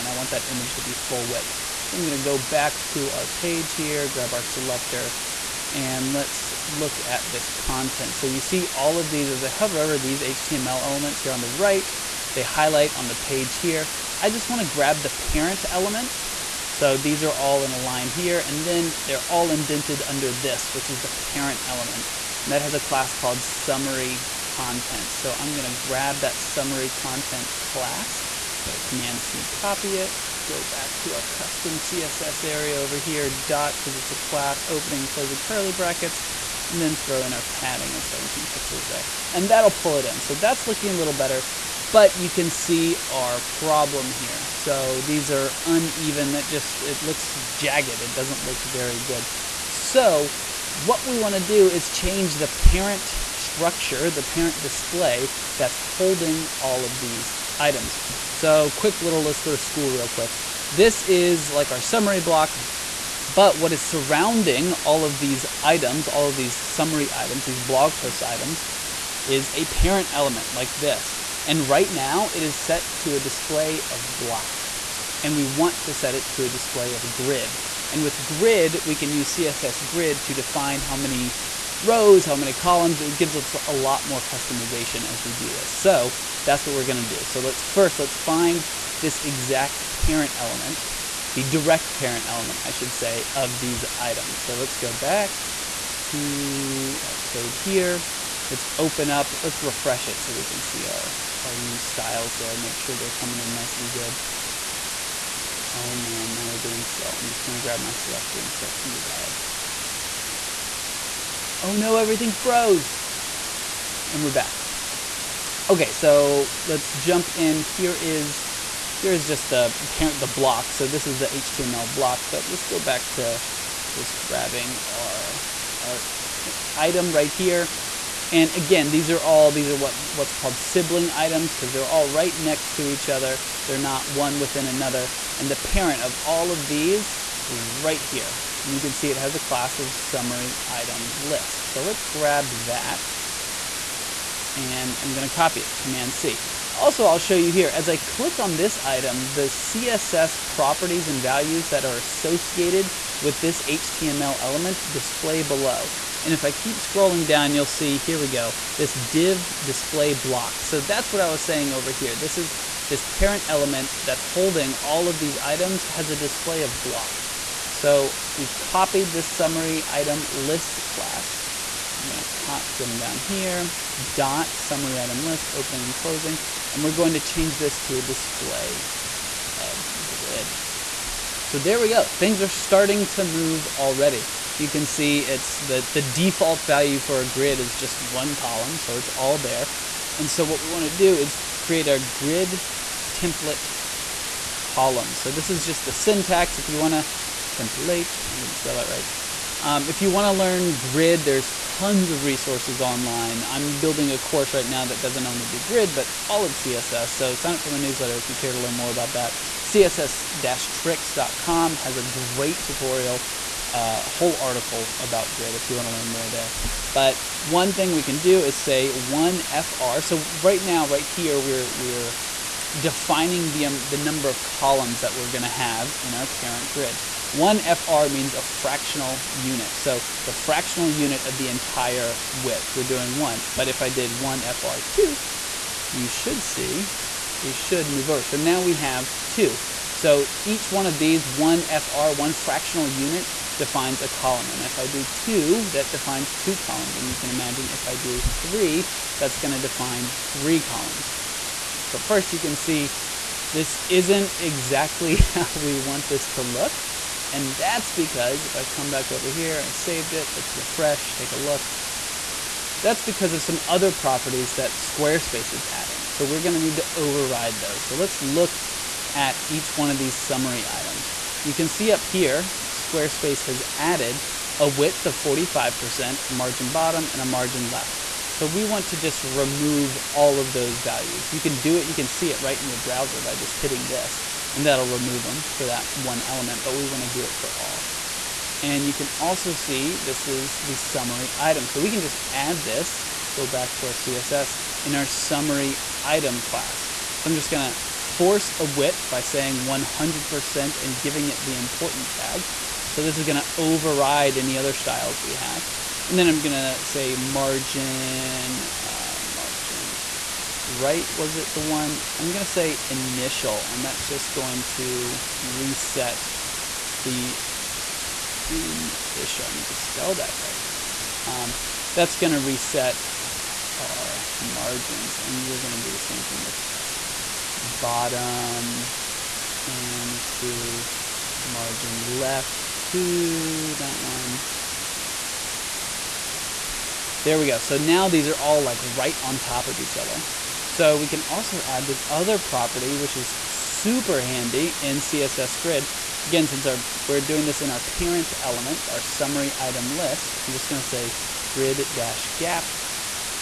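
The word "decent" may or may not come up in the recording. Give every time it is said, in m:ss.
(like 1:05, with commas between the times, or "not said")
not said.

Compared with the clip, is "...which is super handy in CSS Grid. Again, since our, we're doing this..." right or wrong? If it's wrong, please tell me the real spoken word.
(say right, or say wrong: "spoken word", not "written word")
right.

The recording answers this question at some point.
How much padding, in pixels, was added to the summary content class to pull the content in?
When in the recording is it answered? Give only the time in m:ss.
0:38.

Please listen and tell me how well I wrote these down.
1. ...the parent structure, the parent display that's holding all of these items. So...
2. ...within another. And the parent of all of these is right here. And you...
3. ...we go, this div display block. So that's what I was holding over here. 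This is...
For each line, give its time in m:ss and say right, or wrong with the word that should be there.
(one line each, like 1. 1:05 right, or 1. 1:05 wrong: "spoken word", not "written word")
1. 0:52 right
2. 2:14 right
3. 2:38 wrong: "saying", not "holding".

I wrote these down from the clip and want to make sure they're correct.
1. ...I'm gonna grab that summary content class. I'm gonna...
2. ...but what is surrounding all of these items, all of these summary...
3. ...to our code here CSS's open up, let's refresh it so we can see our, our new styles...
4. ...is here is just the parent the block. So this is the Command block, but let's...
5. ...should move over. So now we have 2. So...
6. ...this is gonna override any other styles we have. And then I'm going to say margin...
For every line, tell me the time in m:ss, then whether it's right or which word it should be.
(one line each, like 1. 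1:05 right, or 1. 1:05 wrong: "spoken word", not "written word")
1. 0:25 right
2. 1:03 right
3. 1:36 wrong: "Let", not "CSS"
4. 1:57 wrong: "HTML", not "Command"
5. 3:57 right
6. 5:03 right.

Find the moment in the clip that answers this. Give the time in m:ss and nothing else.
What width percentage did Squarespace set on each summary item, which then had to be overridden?
4:35.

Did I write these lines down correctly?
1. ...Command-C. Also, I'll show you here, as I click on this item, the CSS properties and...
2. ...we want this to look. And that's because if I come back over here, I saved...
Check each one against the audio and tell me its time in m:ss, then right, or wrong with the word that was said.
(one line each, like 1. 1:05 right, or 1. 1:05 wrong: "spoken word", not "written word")
1. 2:25 right
2. 4:15 right.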